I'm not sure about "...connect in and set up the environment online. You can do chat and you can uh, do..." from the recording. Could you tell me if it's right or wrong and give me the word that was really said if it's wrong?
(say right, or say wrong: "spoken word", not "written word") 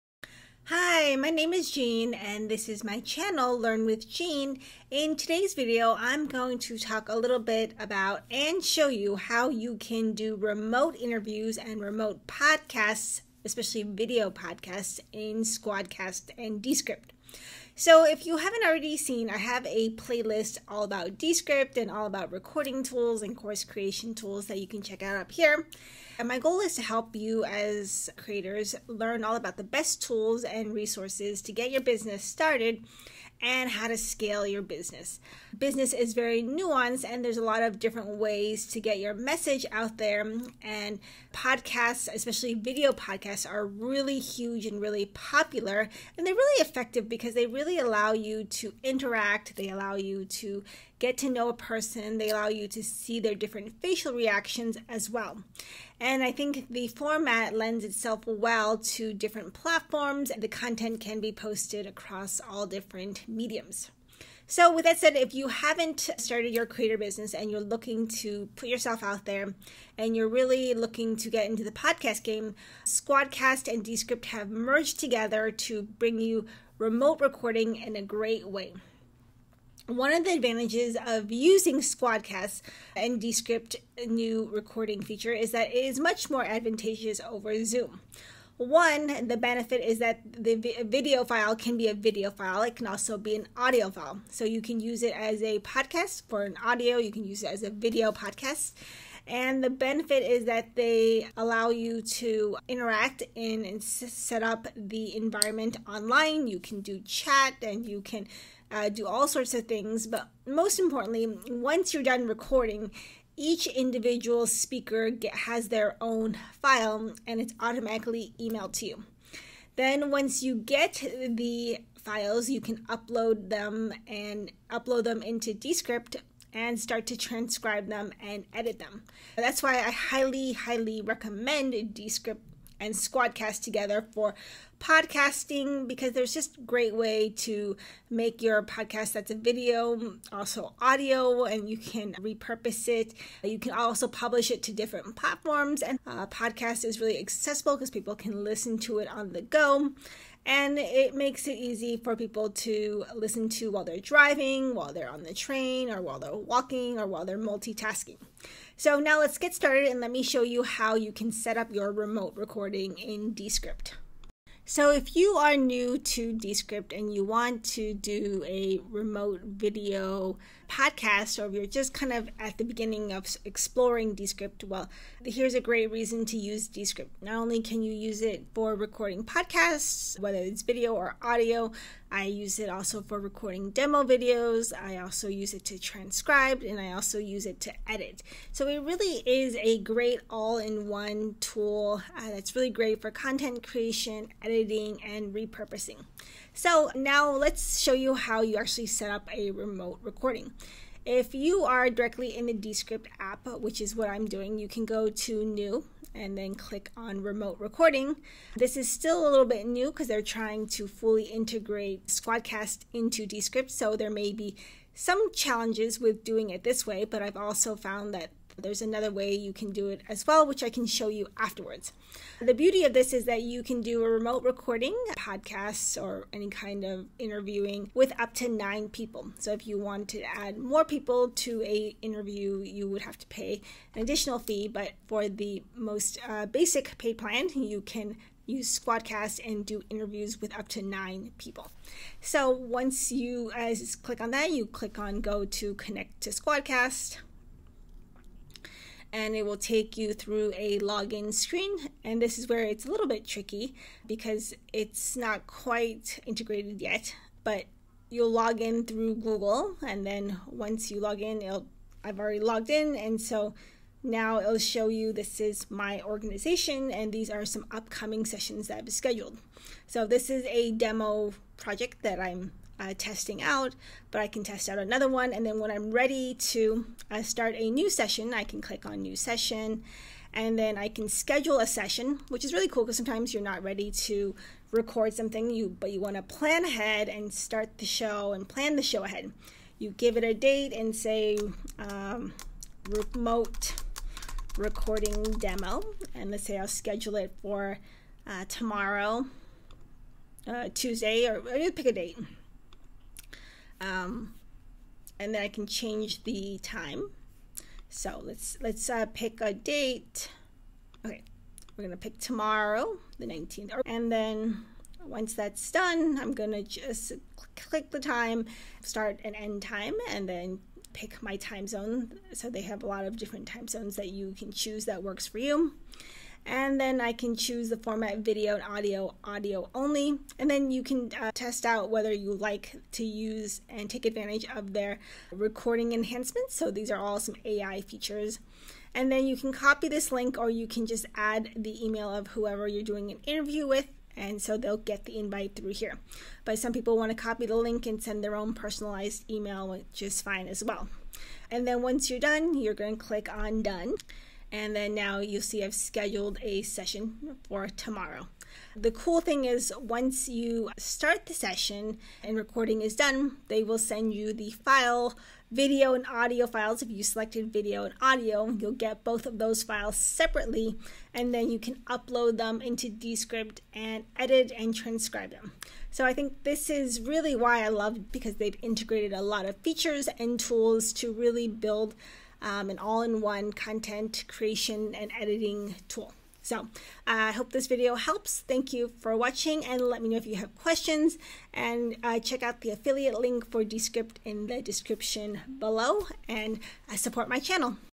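wrong: "interact", not "connect".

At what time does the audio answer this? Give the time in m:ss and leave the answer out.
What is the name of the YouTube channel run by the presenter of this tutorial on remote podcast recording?
0:03.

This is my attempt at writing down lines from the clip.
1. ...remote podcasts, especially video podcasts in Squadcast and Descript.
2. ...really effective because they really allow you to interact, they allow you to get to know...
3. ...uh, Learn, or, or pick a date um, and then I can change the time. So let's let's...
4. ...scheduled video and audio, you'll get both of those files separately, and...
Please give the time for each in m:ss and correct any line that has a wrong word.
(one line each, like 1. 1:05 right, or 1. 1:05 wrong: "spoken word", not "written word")
1. 0:11 right
2. 0:46 right
3. 5:00 wrong: "Tuesday", not "Learn"
4. 6:07 wrong: "selected", not "scheduled".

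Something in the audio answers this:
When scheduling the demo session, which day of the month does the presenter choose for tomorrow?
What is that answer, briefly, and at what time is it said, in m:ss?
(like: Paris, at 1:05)
19th, at 5:13.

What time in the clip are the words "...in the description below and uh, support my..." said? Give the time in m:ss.
6:34.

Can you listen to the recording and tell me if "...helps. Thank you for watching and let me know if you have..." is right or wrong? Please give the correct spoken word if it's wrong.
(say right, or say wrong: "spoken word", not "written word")
right.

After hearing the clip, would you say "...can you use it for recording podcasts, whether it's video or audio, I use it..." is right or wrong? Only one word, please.
right.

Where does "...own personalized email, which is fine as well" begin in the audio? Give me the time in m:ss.
5:48.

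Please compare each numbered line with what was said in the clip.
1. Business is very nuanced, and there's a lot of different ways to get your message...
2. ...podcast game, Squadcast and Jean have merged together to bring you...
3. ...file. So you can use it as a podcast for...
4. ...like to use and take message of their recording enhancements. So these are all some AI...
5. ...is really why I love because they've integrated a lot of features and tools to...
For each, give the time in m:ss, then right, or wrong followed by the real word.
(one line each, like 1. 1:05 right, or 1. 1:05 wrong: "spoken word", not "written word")
1. 0:35 right
2. 1:11 wrong: "Descript", not "Jean"
3. 1:33 right
4. 5:32 wrong: "advantage", not "message"
5. 6:16 right.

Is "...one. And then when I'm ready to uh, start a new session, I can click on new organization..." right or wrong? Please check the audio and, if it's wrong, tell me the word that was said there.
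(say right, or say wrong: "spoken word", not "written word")
wrong: "session", not "organization".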